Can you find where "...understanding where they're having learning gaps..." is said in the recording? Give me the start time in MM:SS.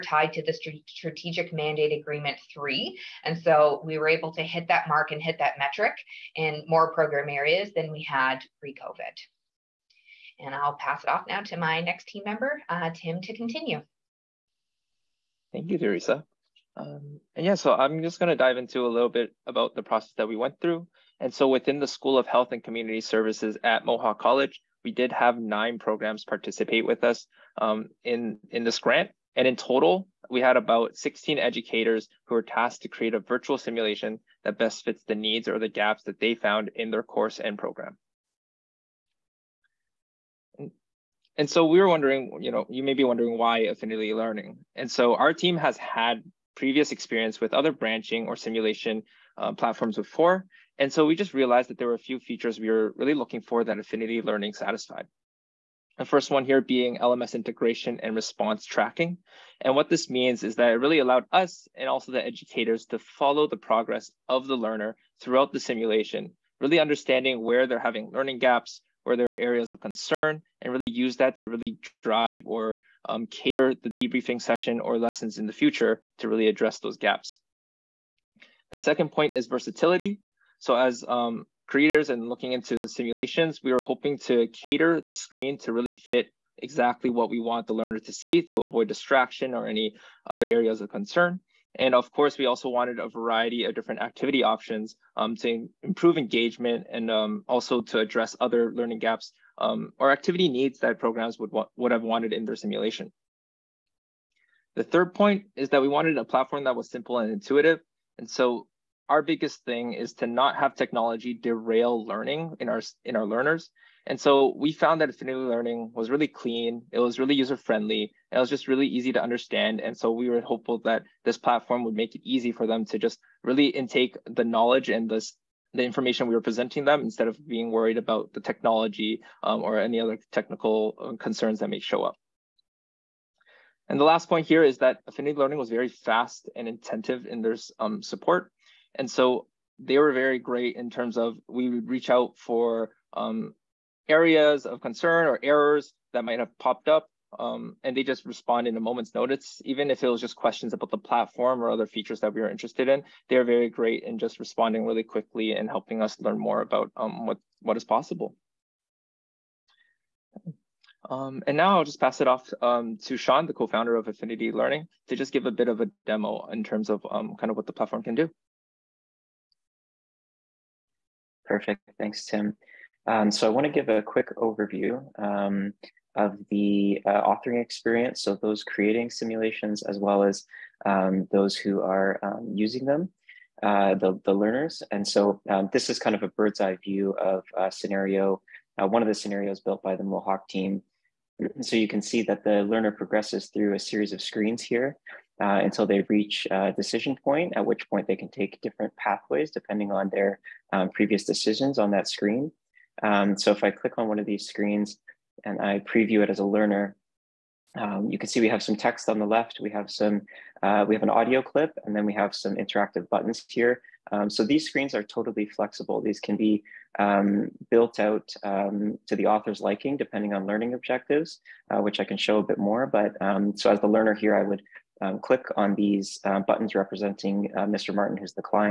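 01:06.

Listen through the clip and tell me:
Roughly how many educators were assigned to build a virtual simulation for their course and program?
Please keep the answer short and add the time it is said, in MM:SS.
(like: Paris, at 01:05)
16, at 00:30.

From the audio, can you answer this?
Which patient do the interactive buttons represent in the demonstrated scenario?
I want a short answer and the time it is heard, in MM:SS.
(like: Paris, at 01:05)
Mr. Martin, at 03:47.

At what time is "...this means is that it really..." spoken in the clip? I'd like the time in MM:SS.
00:59.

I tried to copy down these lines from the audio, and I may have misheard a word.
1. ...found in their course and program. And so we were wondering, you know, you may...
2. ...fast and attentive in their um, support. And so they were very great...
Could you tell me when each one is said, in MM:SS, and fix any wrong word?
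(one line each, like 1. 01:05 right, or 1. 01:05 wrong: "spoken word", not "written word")
1. 00:36 right
2. 02:15 right.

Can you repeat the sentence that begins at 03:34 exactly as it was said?
Um, so these screens are totally flexible.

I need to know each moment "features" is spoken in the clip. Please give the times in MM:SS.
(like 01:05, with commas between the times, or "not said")
00:52, 02:31.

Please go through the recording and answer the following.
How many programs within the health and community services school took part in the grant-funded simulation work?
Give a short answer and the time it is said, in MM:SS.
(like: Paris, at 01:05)
9, at 00:25.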